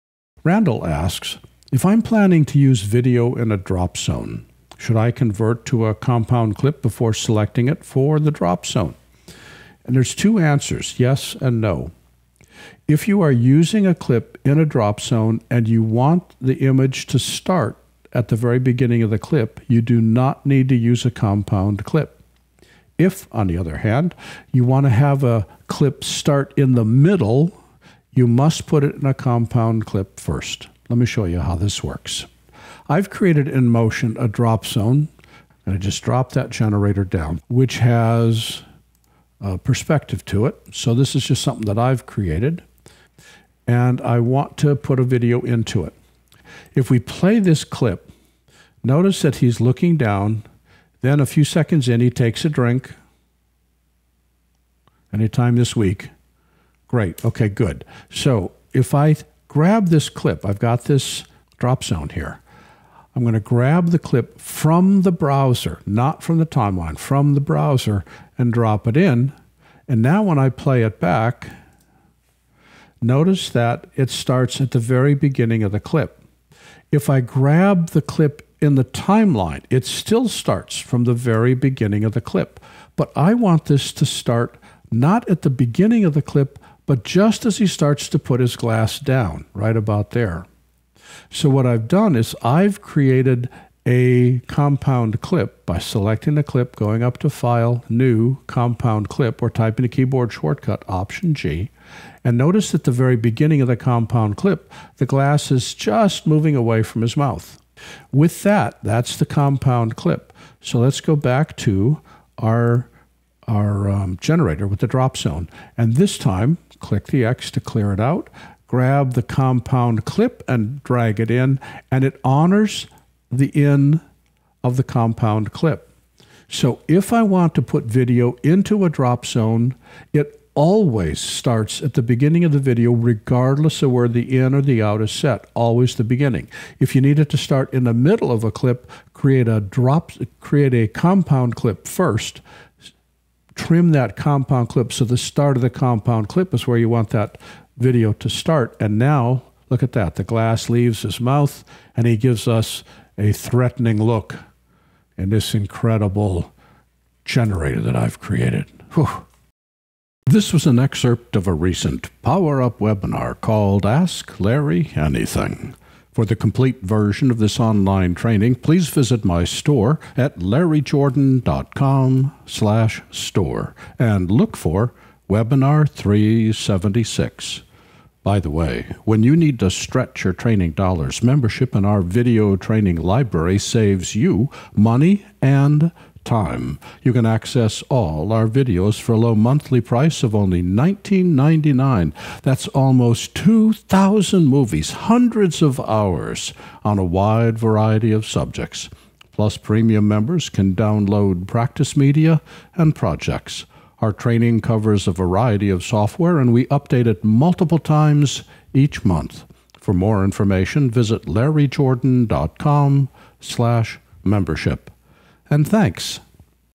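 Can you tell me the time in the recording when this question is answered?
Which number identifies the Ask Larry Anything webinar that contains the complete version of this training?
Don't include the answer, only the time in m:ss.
2:55.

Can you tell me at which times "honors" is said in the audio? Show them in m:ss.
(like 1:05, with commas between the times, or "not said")
2:02.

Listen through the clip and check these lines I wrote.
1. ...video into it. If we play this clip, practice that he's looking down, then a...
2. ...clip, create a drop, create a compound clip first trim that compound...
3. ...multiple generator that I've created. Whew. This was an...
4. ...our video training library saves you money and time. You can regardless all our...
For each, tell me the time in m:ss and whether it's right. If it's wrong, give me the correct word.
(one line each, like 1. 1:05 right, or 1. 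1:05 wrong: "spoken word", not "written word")
1. 0:45 wrong: "notice", not "practice"
2. 2:18 right
3. 2:35 wrong: "incredible", not "multiple"
4. 3:01 wrong: "access", not "regardless".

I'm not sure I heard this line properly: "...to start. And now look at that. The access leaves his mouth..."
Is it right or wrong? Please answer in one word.
wrong.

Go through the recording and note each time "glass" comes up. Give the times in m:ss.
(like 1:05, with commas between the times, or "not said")
1:28, 1:45, 2:30.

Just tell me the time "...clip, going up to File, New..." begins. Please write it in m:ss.
1:36.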